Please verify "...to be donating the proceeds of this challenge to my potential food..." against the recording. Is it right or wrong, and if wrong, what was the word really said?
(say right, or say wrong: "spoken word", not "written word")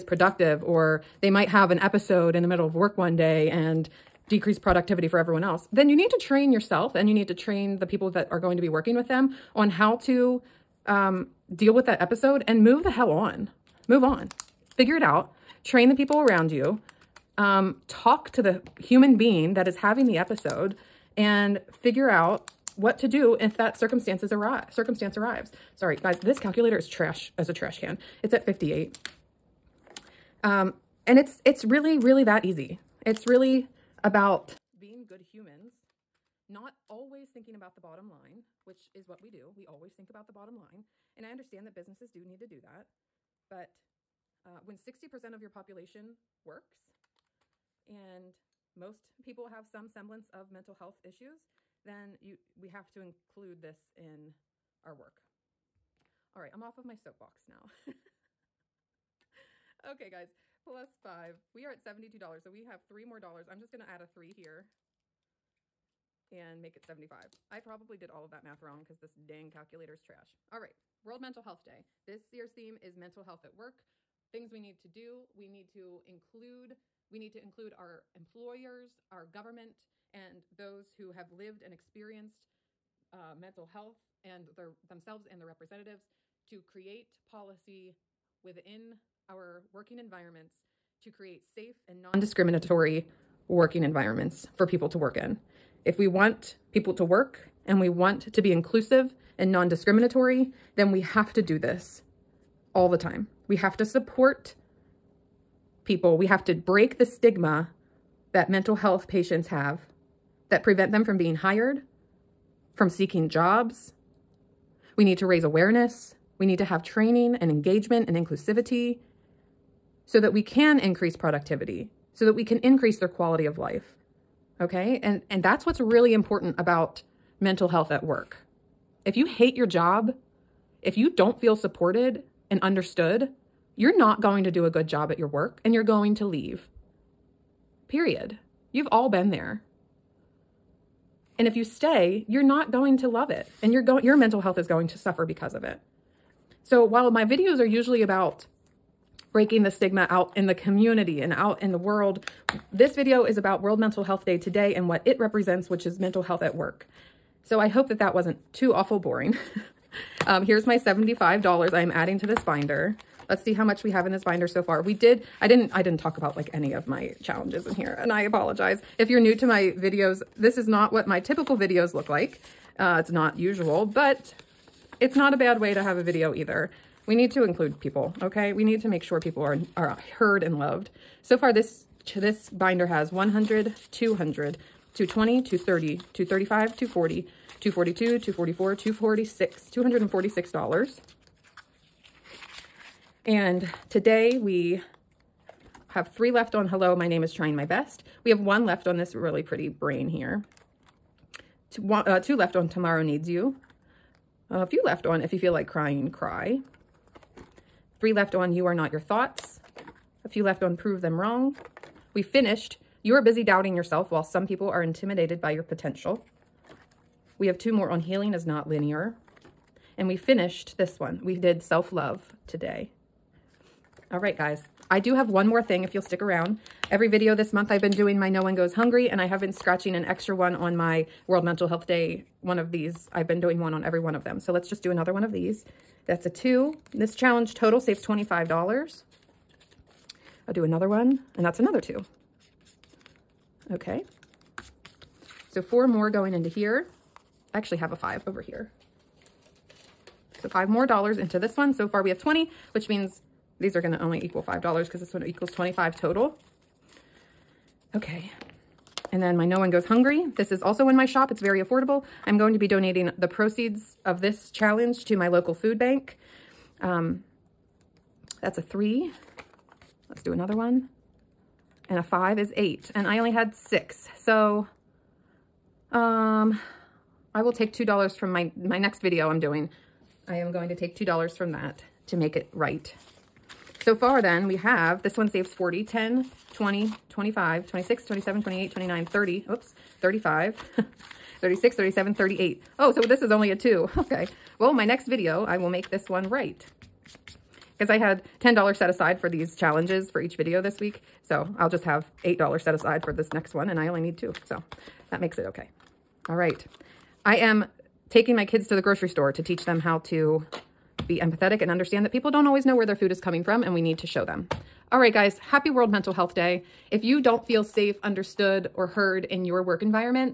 wrong: "local", not "potential".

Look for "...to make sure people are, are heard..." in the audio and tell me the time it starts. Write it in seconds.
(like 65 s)
178 s.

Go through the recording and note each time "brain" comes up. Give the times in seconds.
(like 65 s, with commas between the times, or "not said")
199 s.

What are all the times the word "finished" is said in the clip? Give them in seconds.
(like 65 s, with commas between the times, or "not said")
212 s, 220 s.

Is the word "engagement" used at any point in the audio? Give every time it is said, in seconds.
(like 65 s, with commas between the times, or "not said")
117 s.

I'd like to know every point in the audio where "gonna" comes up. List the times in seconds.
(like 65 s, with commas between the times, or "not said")
63 s, 253 s.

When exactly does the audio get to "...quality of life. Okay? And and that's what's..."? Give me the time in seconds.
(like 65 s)
123 s.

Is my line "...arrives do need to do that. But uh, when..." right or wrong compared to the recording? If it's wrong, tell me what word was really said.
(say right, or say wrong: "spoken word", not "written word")
wrong: "businesses", not "arrives".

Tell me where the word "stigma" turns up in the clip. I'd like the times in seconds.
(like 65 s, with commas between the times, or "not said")
107 s, 149 s.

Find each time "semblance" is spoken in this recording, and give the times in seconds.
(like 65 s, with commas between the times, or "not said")
49 s.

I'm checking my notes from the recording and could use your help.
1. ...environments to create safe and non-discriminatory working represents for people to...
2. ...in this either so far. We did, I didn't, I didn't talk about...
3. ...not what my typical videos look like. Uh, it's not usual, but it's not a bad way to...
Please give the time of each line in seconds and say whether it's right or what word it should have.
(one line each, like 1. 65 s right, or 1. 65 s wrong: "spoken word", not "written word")
1. 89 s wrong: "environments", not "represents"
2. 164 s wrong: "binder", not "either"
3. 170 s right.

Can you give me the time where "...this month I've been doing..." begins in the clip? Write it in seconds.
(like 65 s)
227 s.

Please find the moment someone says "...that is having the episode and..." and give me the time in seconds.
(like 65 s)
19 s.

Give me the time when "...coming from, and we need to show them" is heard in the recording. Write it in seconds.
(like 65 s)
313 s.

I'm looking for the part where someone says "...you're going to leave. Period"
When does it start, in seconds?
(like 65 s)
135 s.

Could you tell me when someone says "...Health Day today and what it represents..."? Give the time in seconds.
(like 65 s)
154 s.